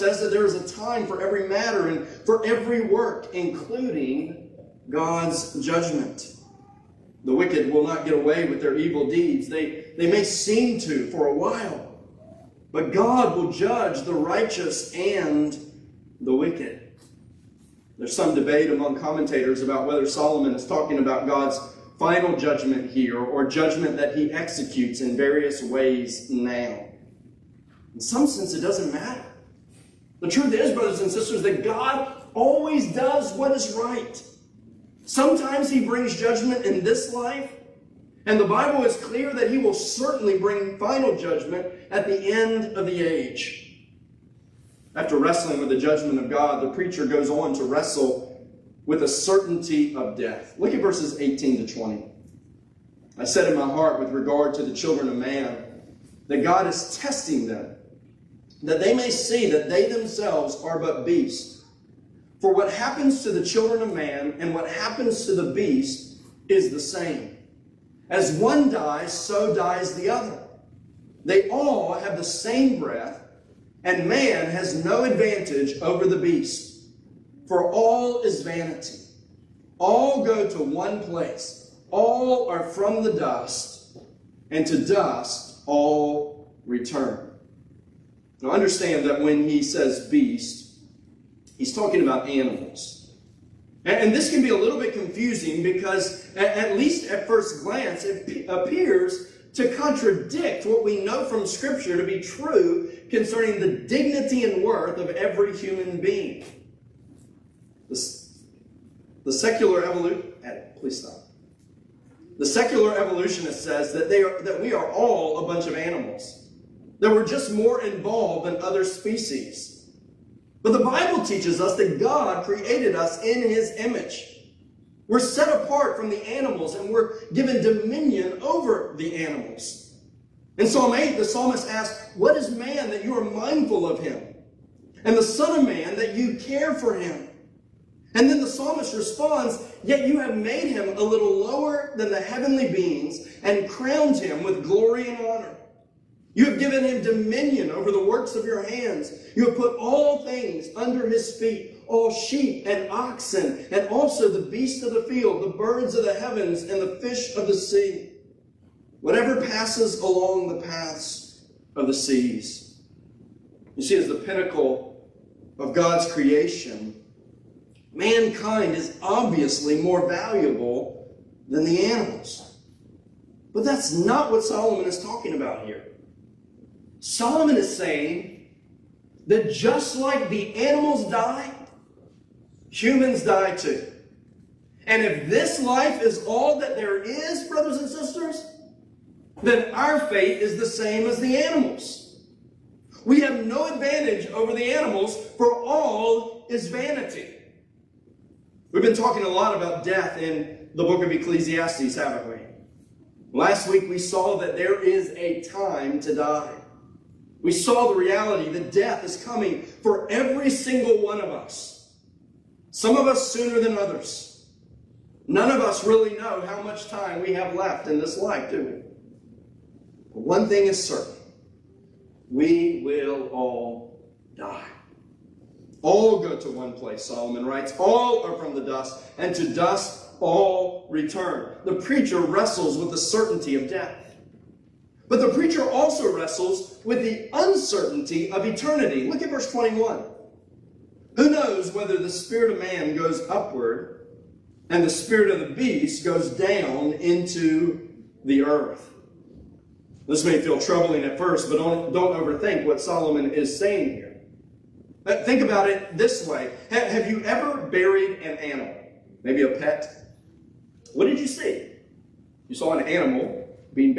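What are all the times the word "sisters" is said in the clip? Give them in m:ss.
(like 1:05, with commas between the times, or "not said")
0:31, 3:07.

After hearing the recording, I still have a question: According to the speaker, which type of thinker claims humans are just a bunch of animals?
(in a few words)
secular evolutionist.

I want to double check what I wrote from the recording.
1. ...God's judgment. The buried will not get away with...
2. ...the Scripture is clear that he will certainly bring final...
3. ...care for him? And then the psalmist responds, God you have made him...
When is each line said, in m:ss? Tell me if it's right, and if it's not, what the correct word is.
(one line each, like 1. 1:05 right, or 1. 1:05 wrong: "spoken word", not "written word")
1. 0:04 wrong: "wicked", not "buried"
2. 0:38 wrong: "Bible", not "Scripture"
3. 2:16 wrong: "Yet", not "God".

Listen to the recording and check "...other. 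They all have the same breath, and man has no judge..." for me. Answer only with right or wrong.
wrong.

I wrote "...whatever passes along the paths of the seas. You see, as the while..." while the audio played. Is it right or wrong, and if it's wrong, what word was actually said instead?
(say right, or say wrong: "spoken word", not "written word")
wrong: "pinnacle", not "while".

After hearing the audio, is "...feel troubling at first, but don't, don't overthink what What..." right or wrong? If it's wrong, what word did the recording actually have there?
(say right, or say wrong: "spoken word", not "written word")
wrong: "Solomon", not "What".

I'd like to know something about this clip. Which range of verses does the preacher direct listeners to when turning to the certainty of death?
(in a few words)
18 to 20.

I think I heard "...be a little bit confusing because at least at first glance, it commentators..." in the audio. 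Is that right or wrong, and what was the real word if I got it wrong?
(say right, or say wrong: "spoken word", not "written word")
wrong: "appears", not "commentators".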